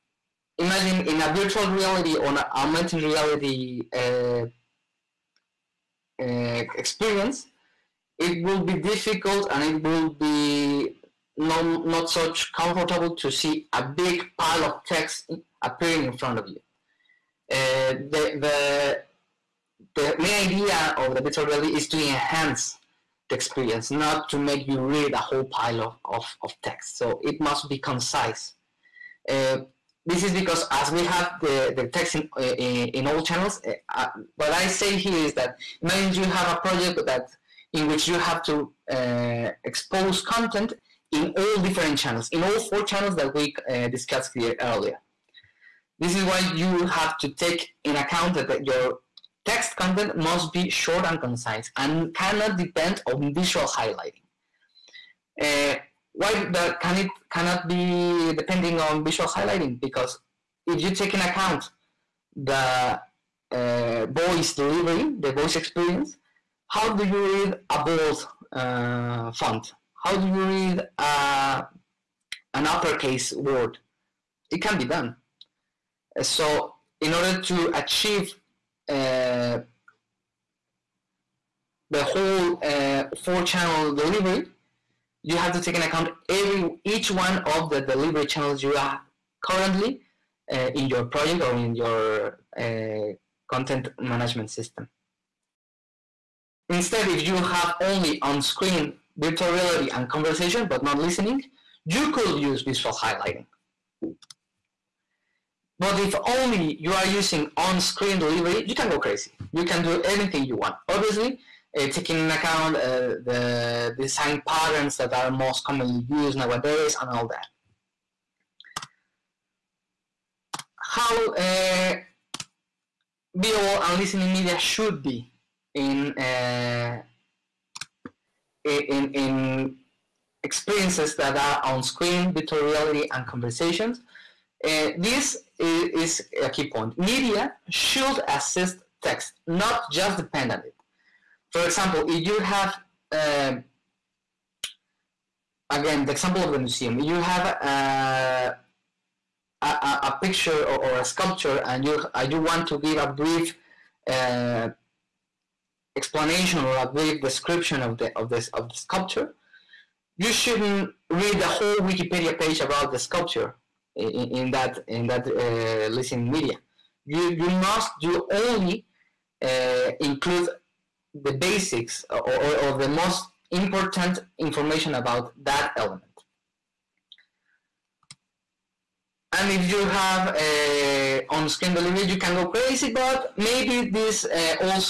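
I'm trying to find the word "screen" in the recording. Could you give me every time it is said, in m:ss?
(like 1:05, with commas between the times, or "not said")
1:38, 1:47, 2:11, 3:01.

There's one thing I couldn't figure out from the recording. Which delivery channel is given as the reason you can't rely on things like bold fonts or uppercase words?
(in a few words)
voice delivery.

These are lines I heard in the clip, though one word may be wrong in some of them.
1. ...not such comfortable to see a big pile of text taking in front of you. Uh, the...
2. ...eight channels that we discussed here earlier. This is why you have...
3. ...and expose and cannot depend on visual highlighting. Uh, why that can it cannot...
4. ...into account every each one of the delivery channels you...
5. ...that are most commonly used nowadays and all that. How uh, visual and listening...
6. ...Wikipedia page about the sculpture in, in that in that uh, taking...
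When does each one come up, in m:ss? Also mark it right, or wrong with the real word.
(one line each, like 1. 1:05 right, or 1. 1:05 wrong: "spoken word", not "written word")
1. 0:11 wrong: "appearing", not "taking"
2. 0:42 wrong: "four", not "eight"
3. 0:51 wrong: "concise", not "expose"
4. 1:25 right
5. 1:54 right
6. 2:41 wrong: "listening", not "taking".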